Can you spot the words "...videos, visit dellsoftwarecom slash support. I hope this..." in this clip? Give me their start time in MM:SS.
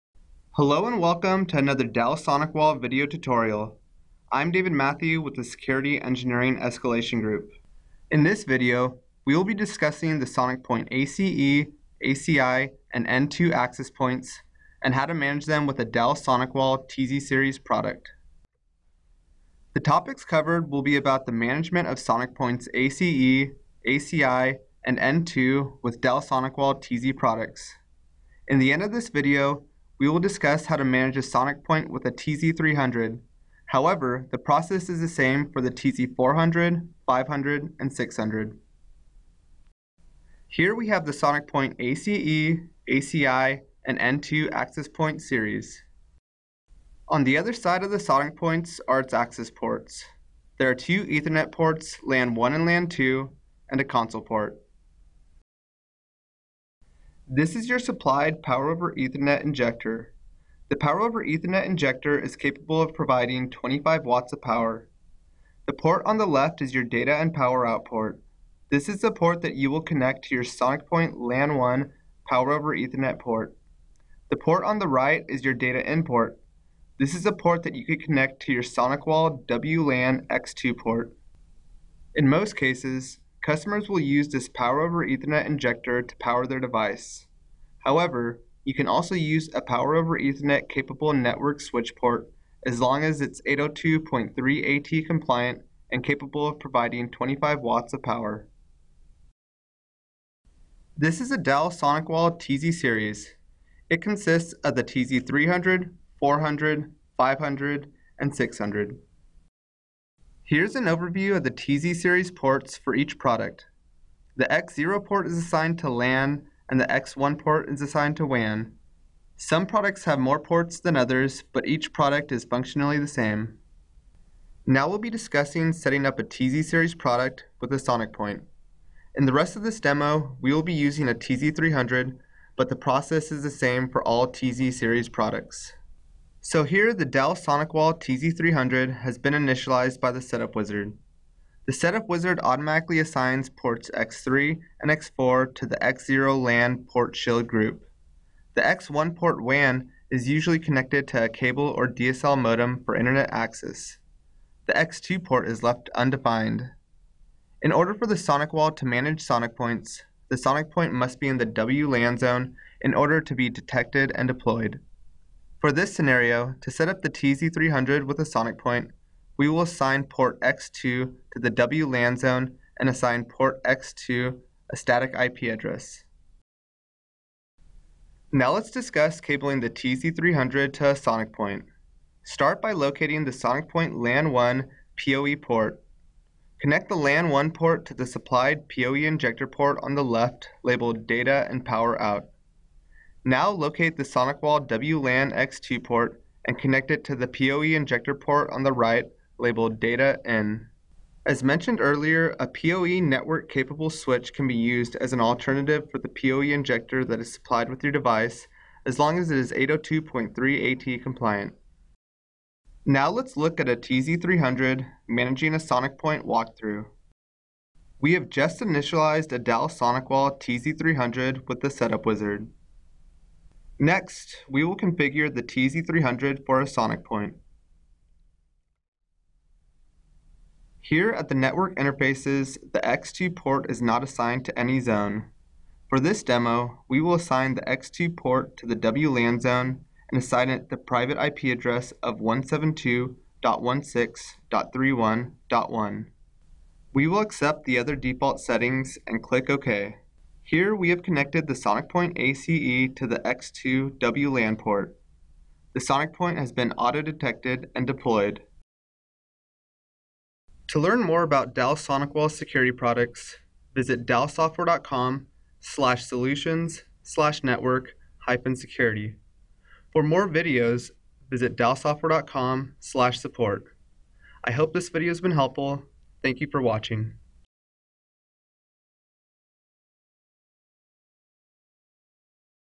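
04:30.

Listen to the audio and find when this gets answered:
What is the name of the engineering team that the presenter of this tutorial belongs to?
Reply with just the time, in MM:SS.
00:05.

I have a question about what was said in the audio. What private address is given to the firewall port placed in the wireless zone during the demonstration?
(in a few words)
172.16.31.1.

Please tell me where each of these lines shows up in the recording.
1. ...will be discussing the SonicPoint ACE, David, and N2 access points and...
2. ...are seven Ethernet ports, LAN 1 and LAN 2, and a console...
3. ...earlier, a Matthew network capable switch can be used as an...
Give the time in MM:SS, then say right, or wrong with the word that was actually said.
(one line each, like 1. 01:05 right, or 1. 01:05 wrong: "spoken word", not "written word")
1. 00:09 wrong: "ACI", not "David"
2. 00:50 wrong: "two", not "seven"
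3. 03:21 wrong: "PoE", not "Matthew".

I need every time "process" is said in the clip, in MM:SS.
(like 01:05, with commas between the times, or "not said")
00:34, 02:12.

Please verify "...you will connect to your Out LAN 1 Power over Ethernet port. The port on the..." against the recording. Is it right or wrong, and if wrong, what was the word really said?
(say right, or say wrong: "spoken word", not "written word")
wrong: "SonicPoint", not "Out".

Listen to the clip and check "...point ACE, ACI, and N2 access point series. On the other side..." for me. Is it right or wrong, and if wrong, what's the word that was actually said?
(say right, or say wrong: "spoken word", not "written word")
right.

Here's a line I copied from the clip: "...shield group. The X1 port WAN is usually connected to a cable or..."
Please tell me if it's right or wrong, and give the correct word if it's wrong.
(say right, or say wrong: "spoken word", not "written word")
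right.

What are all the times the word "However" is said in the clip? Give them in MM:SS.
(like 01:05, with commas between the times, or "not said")
00:33, 01:27.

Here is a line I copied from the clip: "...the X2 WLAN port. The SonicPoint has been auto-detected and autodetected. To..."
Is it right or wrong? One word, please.
wrong.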